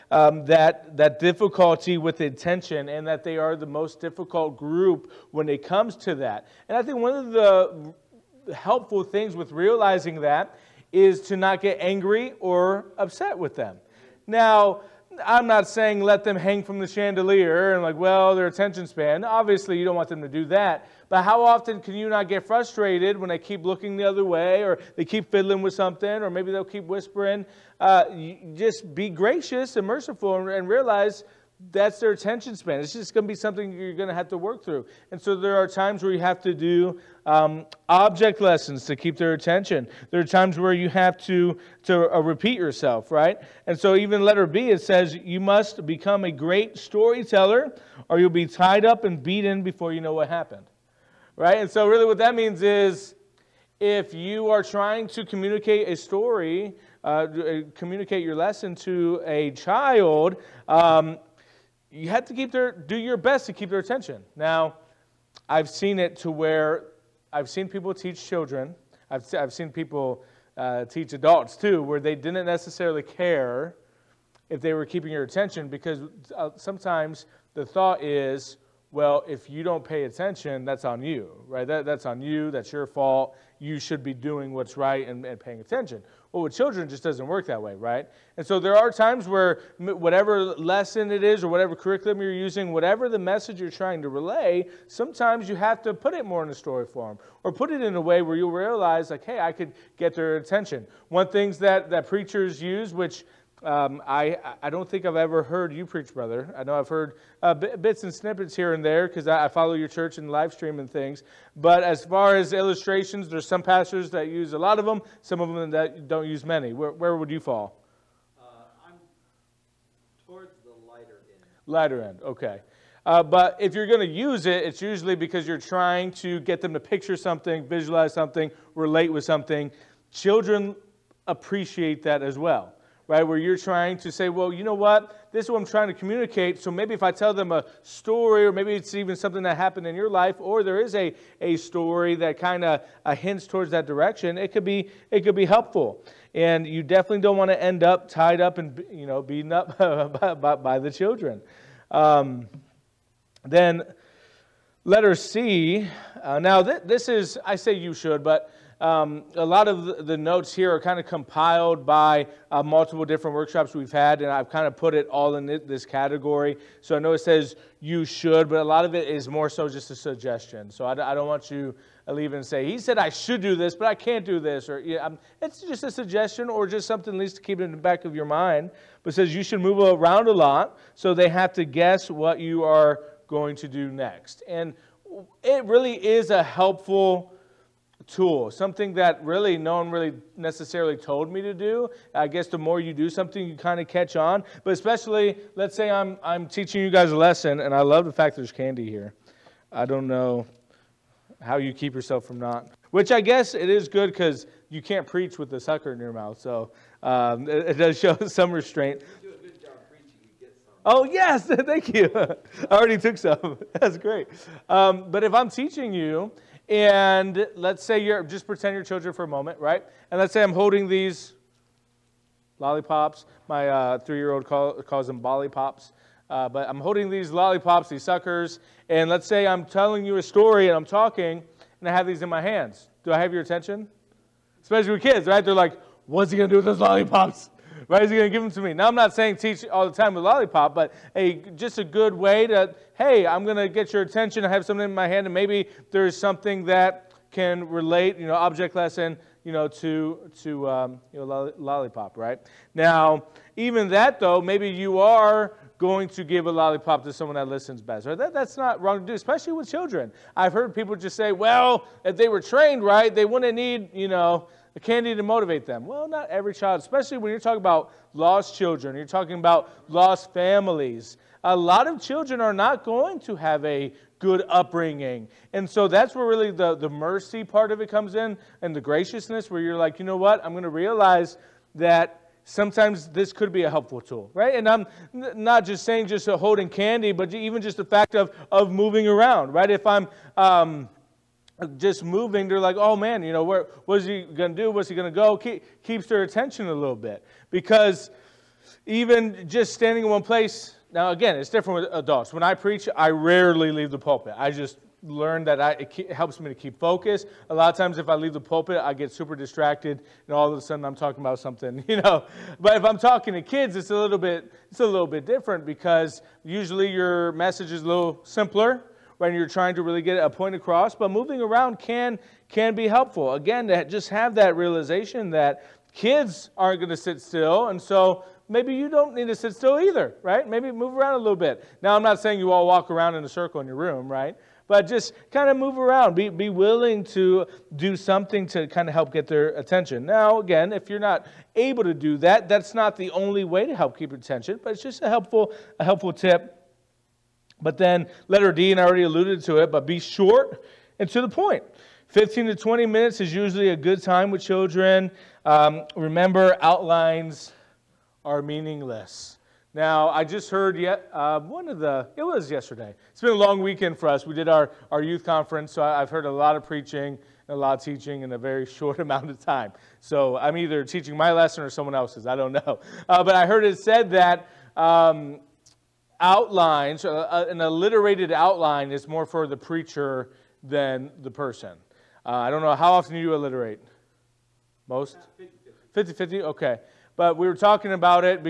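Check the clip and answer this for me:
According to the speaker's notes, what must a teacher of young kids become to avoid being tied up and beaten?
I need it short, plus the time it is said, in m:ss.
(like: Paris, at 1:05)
A great storyteller, at 0:46.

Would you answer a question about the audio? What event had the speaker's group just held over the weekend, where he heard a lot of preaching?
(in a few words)
Youth conference.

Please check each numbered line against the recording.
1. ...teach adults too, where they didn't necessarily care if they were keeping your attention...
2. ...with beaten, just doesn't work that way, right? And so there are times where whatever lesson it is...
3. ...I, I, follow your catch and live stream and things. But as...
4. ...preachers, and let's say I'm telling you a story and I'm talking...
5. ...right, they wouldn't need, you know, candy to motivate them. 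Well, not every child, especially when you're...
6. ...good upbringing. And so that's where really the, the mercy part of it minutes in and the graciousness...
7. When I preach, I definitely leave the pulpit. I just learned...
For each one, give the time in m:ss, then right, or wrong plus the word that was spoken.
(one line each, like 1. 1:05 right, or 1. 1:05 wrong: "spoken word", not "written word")
1. 1:10 right
2. 1:26 wrong: "children", not "beaten"
3. 1:49 wrong: "church", not "catch"
4. 3:48 wrong: "suckers", not "preachers"
5. 4:22 right
6. 4:34 wrong: "comes", not "minutes"
7. 5:02 wrong: "rarely", not "definitely".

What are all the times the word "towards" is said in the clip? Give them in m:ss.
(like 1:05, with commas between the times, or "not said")
2:00, 2:23.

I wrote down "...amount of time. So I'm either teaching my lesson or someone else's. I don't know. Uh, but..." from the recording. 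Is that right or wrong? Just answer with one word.
right.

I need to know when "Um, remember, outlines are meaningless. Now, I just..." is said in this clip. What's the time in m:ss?
5:55.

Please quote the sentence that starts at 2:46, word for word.
So I know it says you should, but a lot of it is more so just a suggestion.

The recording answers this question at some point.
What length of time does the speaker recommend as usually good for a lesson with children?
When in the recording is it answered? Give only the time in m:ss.
5:52.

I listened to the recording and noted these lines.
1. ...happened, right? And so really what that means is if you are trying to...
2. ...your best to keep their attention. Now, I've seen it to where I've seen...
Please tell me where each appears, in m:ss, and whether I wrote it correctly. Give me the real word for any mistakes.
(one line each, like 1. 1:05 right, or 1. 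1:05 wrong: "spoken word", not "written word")
1. 0:50 right
2. 1:02 right.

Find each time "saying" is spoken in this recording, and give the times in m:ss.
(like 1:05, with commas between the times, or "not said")
0:15, 3:59, 4:45, 5:32.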